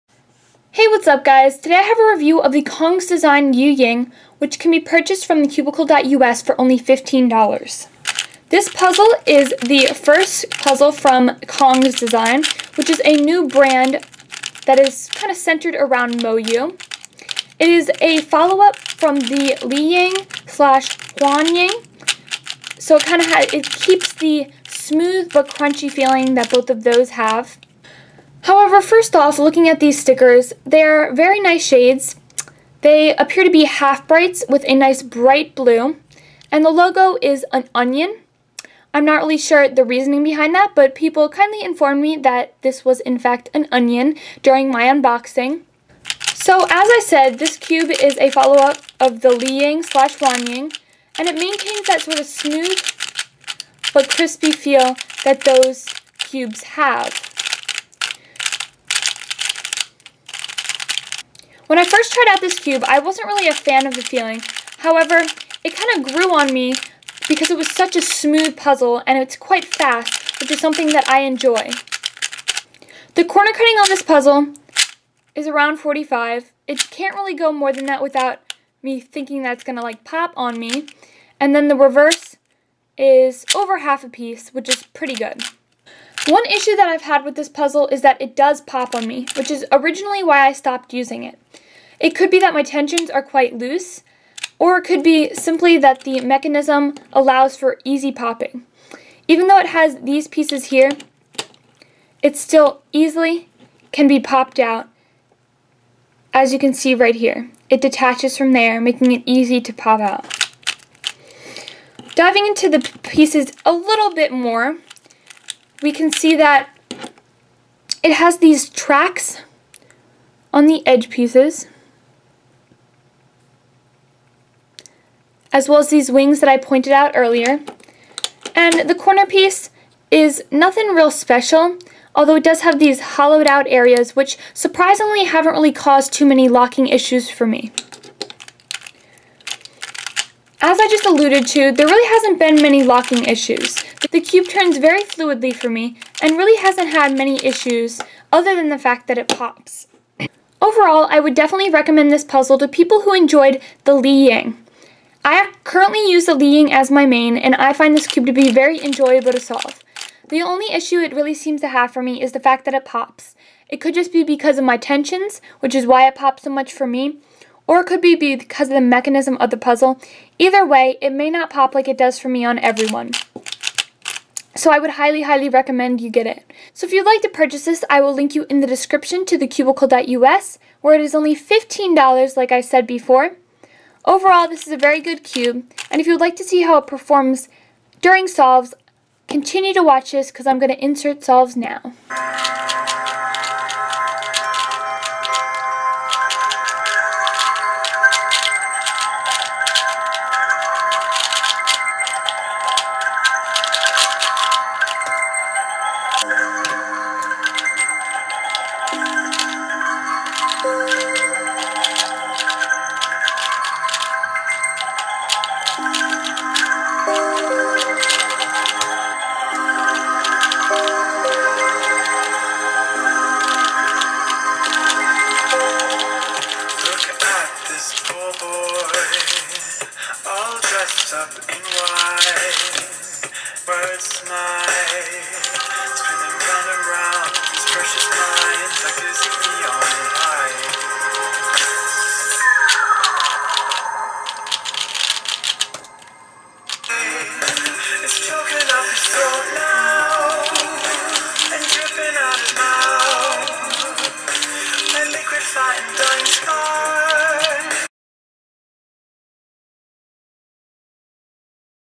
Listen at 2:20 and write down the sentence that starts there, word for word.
As I just alluded to, there really hasn't been many locking issues.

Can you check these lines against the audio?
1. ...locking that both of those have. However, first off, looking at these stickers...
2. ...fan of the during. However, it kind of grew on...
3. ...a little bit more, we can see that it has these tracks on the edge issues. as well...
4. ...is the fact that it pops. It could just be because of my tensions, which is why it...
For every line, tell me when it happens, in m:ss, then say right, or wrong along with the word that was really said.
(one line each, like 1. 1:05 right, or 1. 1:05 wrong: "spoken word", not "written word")
1. 0:25 wrong: "feeling", not "locking"
2. 1:03 wrong: "feeling", not "during"
3. 1:53 wrong: "pieces", not "issues"
4. 2:42 right.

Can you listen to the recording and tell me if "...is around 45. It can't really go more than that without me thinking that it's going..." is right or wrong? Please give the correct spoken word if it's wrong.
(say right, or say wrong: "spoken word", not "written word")
right.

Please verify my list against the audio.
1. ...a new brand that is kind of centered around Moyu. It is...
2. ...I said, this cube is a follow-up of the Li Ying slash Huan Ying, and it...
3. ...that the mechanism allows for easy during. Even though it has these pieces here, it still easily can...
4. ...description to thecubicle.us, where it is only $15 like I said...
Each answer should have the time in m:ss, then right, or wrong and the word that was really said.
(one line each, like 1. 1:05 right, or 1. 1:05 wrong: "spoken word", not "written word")
1. 0:13 right
2. 0:46 right
3. 1:35 wrong: "popping", not "during"
4. 2:58 right.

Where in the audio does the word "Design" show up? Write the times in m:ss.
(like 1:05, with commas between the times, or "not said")
0:03, 0:11.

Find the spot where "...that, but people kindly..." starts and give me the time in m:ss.
0:40.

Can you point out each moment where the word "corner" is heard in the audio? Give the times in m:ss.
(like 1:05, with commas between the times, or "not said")
1:13, 2:08.